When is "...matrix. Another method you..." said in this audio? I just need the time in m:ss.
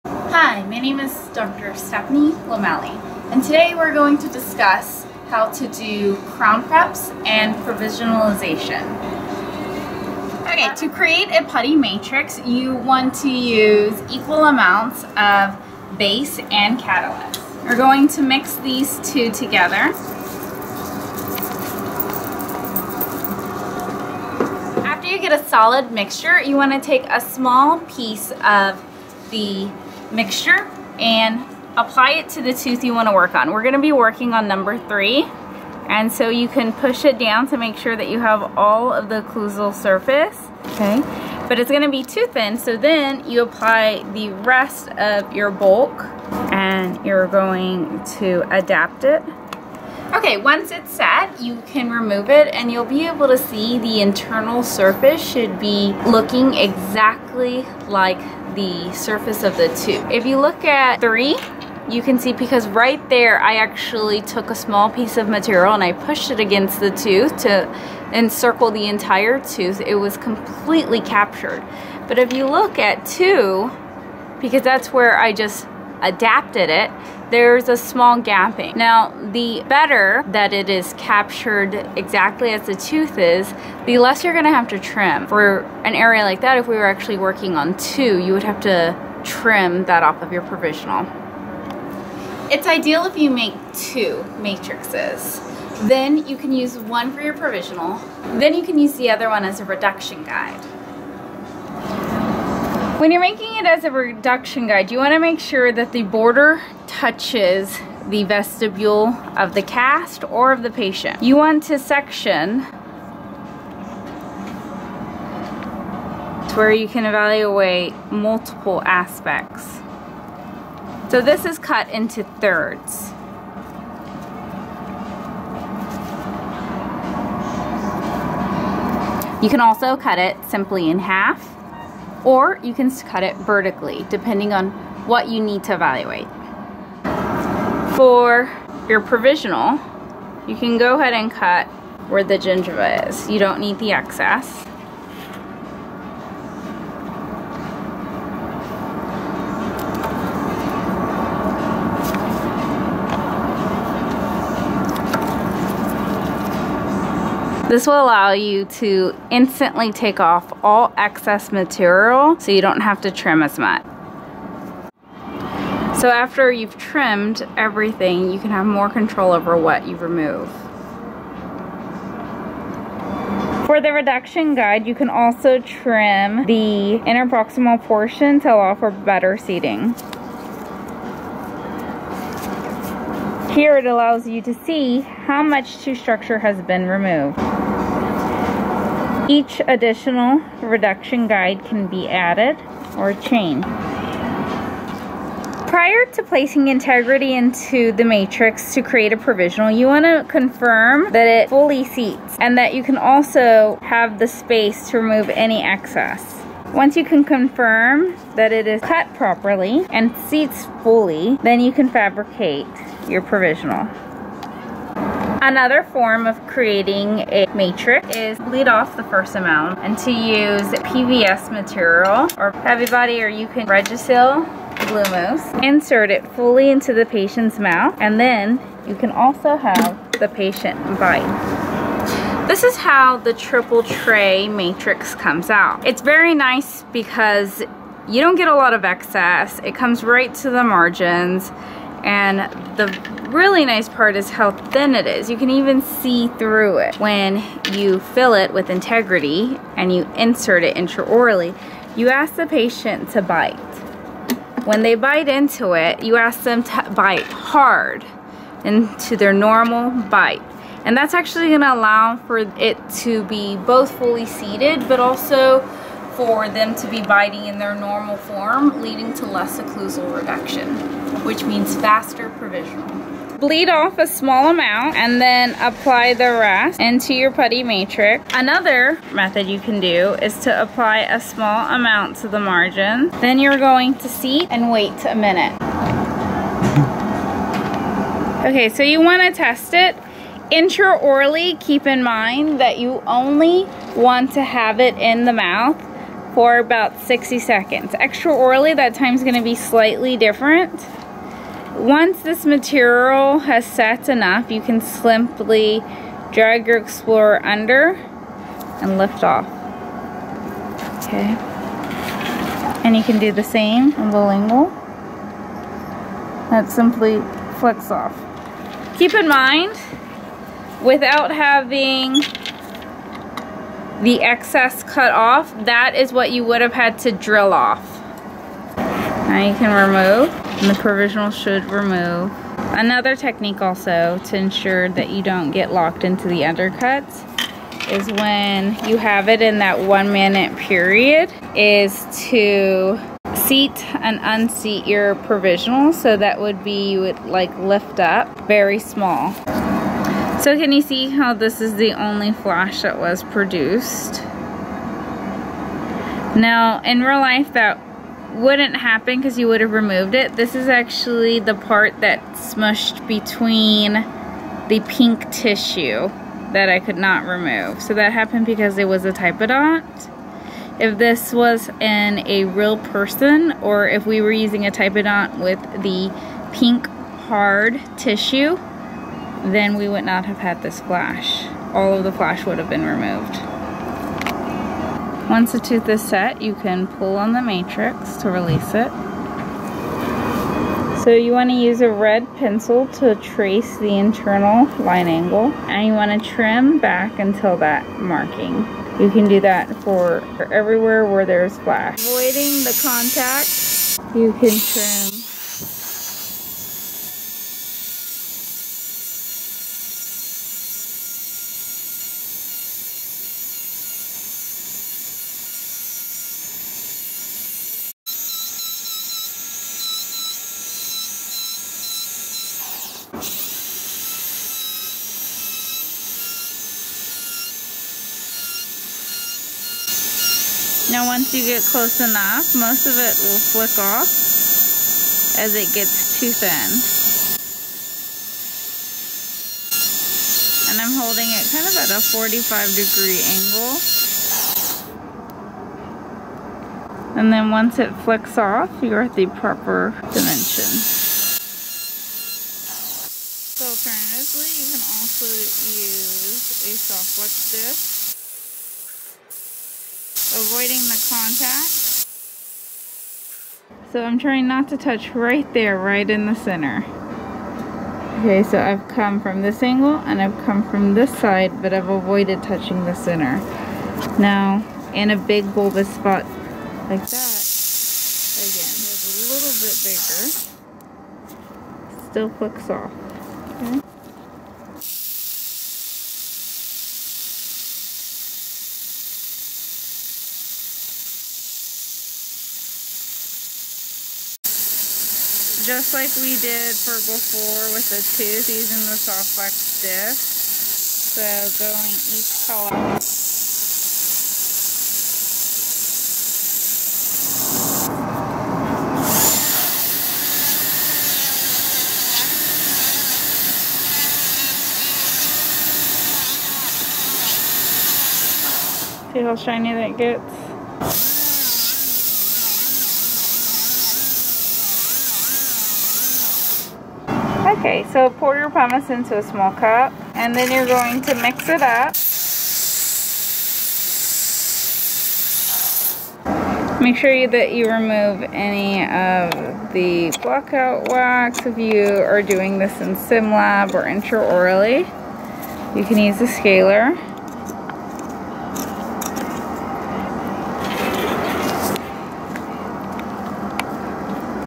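4:37.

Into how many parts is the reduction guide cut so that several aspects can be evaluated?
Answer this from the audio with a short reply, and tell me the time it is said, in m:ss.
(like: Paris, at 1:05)
Thirds, at 2:02.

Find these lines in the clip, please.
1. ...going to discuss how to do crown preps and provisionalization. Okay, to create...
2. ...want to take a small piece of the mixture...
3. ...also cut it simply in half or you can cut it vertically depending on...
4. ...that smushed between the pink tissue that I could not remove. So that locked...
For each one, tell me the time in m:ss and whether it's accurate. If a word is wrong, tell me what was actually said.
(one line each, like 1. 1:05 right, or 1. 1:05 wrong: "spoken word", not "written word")
1. 0:03 right
2. 0:26 right
3. 2:09 right
4. 6:02 wrong: "happened", not "locked".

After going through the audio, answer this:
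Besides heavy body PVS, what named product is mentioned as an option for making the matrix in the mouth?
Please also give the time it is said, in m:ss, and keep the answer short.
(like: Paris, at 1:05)
Regisil, at 3:43.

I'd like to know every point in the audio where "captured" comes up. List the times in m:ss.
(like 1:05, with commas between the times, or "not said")
1:11, 1:20.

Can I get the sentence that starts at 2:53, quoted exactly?
For the reduction guide, you can also trim the interproximal portion to allow for better seating.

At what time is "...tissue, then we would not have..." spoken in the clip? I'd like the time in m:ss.
6:17.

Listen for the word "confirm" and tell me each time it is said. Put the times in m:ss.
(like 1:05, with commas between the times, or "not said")
3:20, 3:27.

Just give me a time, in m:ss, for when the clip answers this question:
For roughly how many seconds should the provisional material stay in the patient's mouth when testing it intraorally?
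4:57.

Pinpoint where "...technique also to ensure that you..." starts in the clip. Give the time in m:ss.
5:33.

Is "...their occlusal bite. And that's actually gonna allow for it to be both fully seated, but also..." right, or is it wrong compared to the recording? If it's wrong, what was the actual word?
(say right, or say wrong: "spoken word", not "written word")
wrong: "normal", not "occlusal".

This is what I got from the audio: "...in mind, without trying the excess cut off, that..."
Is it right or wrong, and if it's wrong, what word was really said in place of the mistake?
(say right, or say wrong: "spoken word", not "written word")
wrong: "having", not "trying".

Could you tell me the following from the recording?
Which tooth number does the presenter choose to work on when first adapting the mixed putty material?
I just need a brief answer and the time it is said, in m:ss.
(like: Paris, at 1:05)
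3, at 0:34.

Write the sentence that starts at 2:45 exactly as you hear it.
So after you've trimmed everything, you can have more control over what you remove.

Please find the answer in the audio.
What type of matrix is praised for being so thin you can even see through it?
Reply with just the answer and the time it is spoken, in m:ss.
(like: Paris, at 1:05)
Triple tray matrix, at 3:53.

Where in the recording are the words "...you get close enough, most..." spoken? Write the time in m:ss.
7:11.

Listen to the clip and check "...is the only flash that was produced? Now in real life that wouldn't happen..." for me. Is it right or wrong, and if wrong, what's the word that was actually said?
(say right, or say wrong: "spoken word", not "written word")
right.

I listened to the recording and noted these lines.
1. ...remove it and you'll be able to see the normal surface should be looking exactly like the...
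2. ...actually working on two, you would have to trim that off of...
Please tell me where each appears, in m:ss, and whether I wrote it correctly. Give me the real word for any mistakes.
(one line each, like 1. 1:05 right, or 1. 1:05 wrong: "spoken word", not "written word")
1. 0:51 wrong: "internal", not "normal"
2. 1:26 right.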